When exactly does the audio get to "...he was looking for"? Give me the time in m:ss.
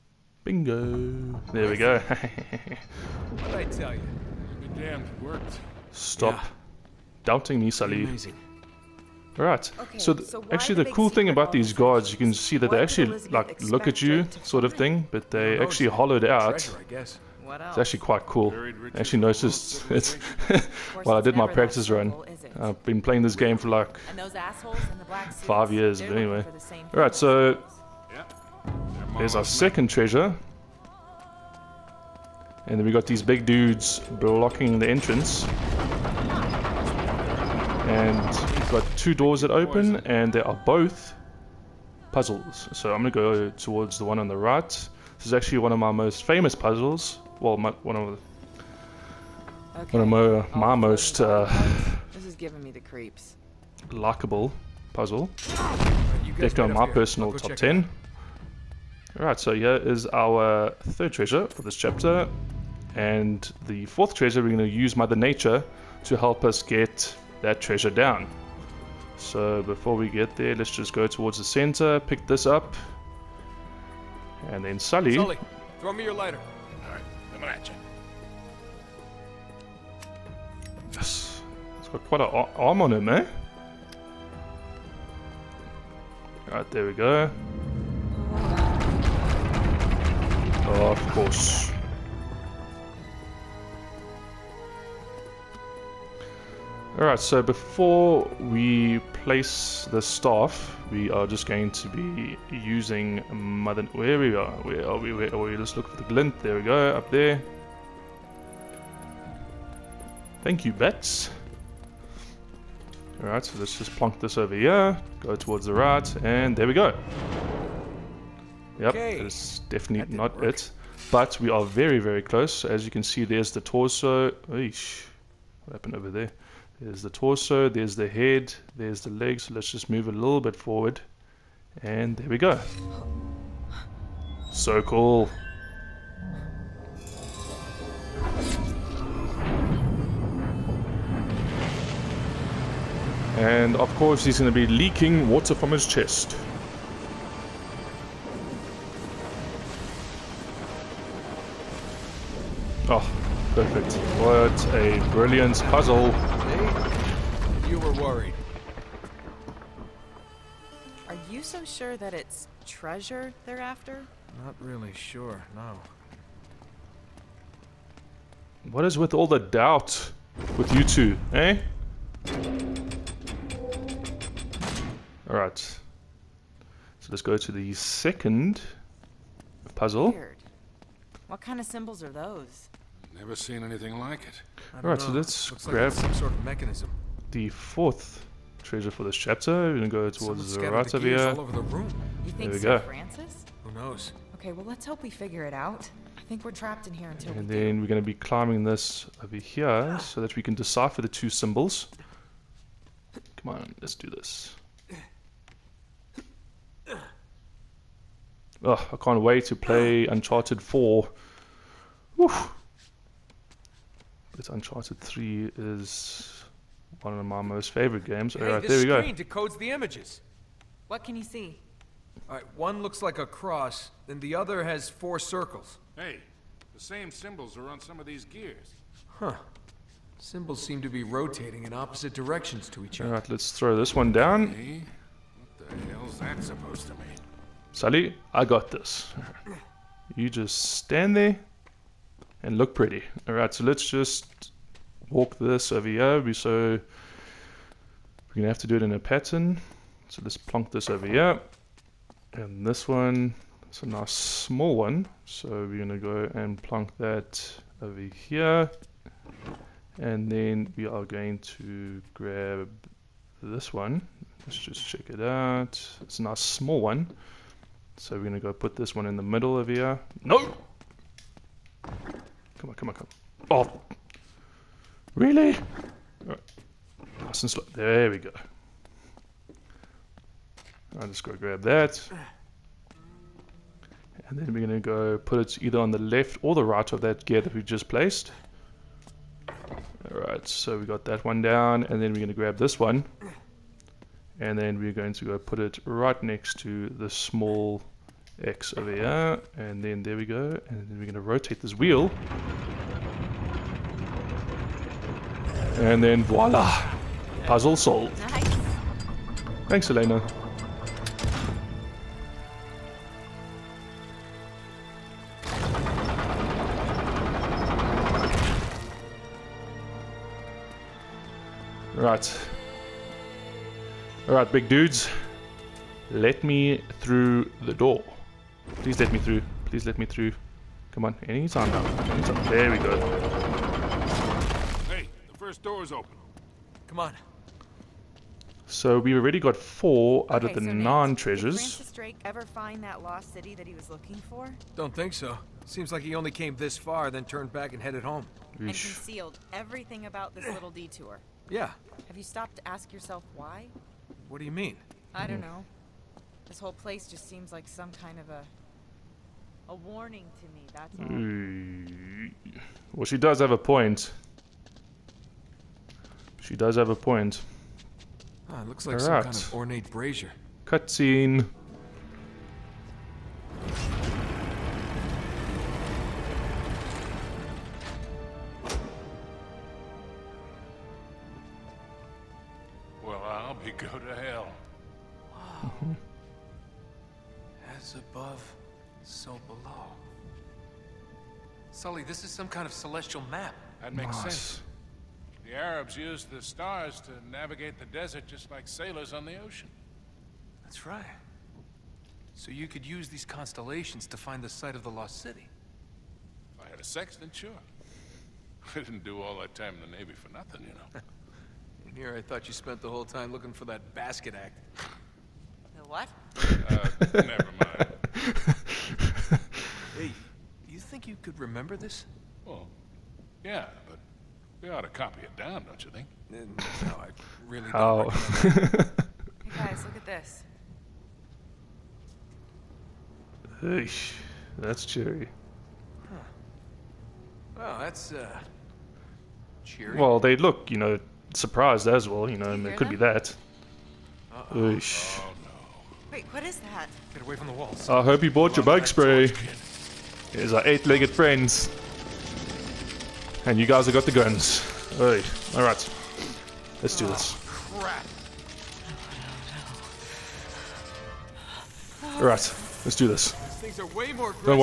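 5:43.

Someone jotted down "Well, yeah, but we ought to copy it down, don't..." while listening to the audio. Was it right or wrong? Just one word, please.
right.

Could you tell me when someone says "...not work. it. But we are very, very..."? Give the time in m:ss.
2:00.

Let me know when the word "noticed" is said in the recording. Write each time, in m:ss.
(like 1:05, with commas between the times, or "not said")
0:19.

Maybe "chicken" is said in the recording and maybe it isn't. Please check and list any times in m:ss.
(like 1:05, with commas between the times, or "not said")
not said.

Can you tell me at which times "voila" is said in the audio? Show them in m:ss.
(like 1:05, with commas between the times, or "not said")
5:06.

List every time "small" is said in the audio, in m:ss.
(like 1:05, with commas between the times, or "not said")
4:14, 4:26, 4:57.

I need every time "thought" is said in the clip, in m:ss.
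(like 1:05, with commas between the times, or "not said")
6:52.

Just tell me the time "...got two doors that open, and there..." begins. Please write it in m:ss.
0:38.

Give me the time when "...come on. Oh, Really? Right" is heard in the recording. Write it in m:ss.
4:32.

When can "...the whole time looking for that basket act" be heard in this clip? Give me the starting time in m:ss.
6:52.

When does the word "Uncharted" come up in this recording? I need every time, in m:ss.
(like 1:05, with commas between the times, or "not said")
3:30, 3:34.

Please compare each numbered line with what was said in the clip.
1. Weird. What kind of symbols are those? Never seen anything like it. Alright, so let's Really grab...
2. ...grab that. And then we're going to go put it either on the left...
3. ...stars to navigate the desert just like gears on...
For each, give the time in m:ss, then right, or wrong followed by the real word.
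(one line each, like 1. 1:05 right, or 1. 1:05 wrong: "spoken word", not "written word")
1. 3:00 wrong: "Looks", not "Really"
2. 4:41 right
3. 6:36 wrong: "sailors", not "gears".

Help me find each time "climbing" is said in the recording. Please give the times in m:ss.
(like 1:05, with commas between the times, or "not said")
3:18.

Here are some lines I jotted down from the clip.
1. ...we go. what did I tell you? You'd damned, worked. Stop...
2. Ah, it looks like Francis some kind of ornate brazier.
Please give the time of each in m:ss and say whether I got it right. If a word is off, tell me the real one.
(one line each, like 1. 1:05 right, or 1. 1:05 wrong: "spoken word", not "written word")
1. 0:01 right
2. 6:08 wrong: "All", not "Francis".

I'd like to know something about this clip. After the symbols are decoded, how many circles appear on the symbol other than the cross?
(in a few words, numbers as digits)
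4.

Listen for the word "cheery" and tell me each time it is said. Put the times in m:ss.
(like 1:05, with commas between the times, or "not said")
7:14, 7:19.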